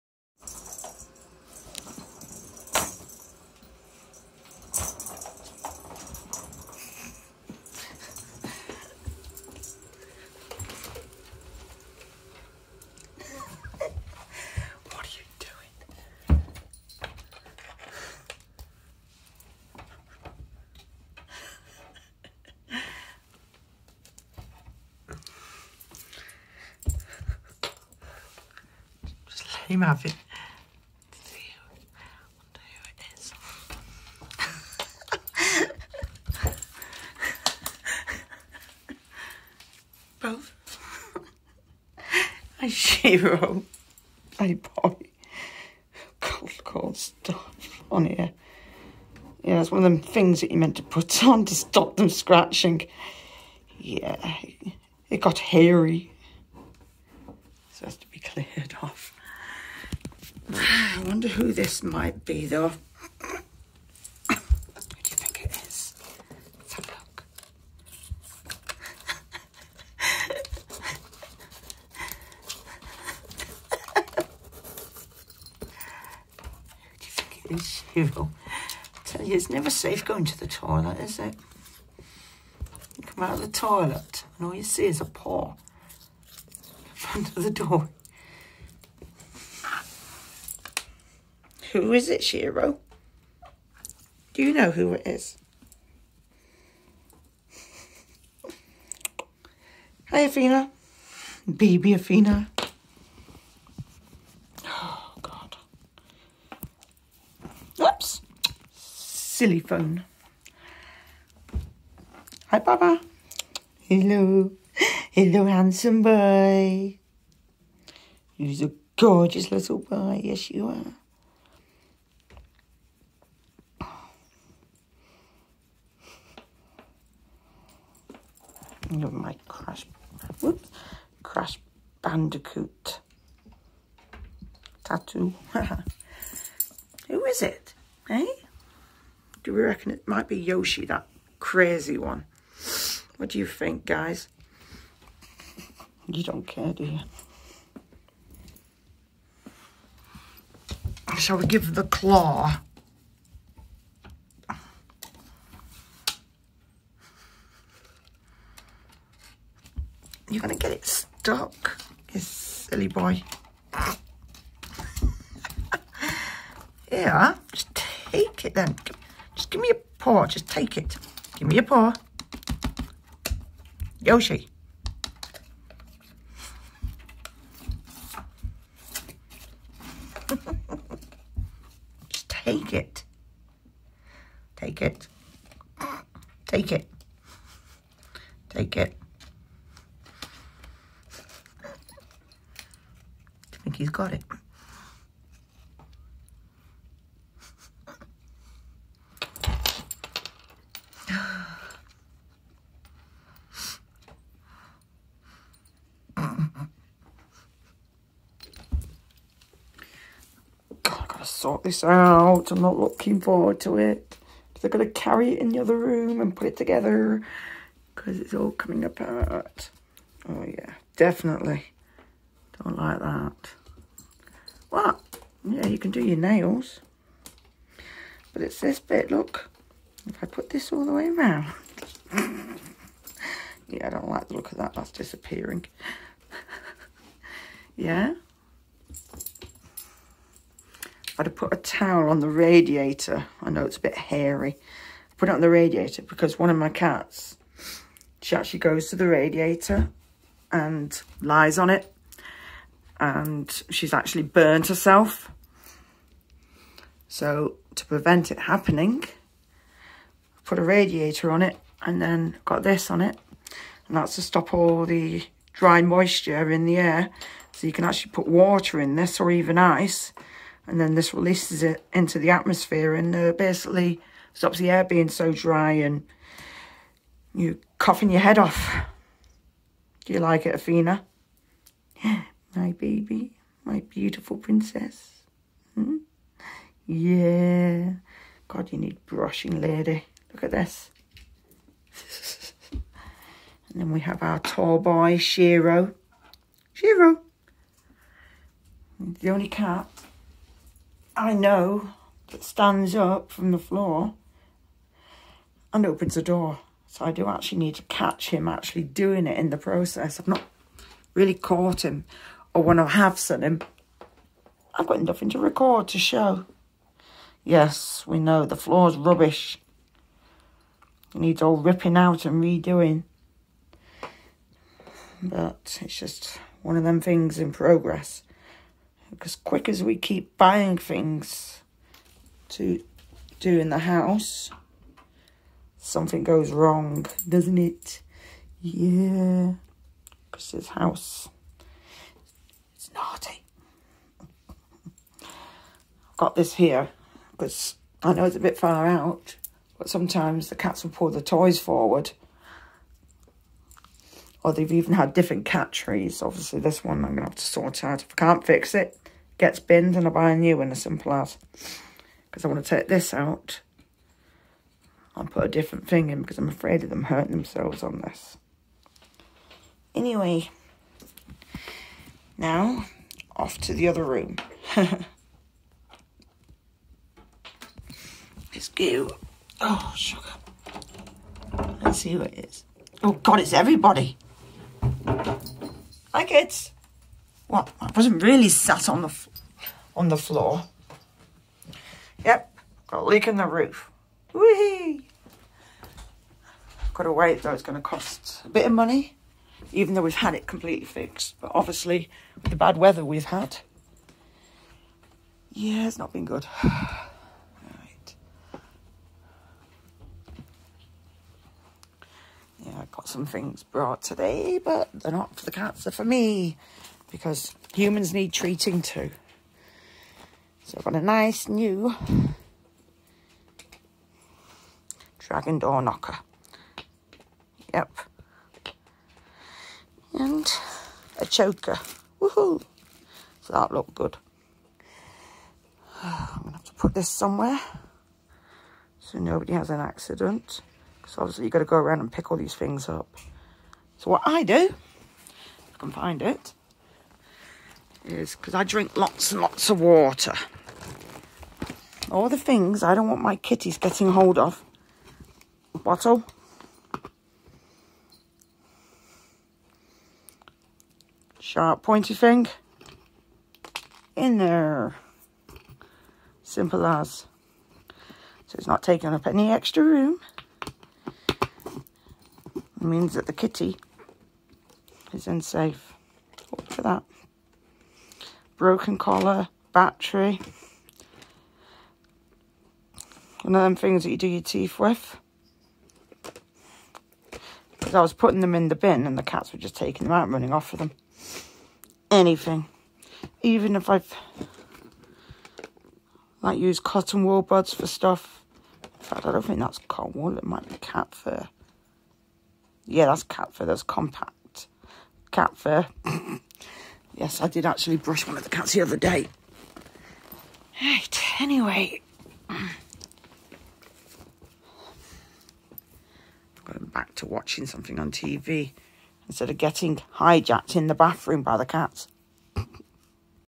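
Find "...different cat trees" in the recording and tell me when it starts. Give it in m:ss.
5:55.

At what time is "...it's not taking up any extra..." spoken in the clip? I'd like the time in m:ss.
7:48.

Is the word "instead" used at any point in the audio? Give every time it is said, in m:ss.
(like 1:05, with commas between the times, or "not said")
8:39.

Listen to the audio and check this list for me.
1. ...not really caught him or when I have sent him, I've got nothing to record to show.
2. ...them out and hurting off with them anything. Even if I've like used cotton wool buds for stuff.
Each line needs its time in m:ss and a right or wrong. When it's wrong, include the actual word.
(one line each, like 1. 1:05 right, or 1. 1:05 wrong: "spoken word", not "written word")
1. 5:10 right
2. 8:10 wrong: "running", not "hurting".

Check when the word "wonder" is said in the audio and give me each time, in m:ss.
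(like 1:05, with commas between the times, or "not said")
0:31, 1:01.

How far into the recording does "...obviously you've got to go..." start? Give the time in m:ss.
7:21.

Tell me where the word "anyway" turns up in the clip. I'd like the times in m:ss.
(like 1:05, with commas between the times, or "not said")
6:09, 8:31.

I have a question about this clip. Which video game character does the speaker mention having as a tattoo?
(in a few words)
Crash Bandicoot.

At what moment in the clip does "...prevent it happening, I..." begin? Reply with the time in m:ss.
4:17.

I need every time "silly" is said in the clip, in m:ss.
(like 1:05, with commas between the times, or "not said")
1:48, 2:42.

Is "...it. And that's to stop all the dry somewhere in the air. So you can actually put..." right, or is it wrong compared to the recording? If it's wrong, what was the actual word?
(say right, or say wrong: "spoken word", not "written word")
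wrong: "moisture", not "somewhere".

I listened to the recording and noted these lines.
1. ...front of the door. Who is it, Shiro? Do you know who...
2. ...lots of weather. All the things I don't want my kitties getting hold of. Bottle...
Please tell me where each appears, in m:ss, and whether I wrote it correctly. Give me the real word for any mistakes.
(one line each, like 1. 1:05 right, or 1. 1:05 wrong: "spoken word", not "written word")
1. 1:26 right
2. 7:29 wrong: "water", not "weather".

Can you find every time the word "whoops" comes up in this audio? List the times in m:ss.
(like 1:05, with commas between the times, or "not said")
1:47, 2:10.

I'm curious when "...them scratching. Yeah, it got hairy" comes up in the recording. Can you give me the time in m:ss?
0:51.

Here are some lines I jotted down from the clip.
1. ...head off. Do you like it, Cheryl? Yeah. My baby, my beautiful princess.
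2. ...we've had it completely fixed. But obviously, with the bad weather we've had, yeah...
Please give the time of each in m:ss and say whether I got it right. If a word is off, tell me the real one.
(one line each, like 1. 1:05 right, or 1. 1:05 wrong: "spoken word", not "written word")
1. 4:38 wrong: "Athena", not "Cheryl"
2. 6:40 right.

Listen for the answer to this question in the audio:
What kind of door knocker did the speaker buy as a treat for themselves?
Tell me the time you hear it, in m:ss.
7:05.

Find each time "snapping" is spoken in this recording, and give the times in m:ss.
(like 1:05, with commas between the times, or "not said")
not said.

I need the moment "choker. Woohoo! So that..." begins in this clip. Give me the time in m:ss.
7:11.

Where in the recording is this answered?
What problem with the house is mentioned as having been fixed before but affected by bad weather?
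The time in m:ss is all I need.
6:33.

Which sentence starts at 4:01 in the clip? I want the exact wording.
I'd have put a towel on the radiator.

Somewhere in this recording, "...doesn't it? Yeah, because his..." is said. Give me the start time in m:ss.
5:37.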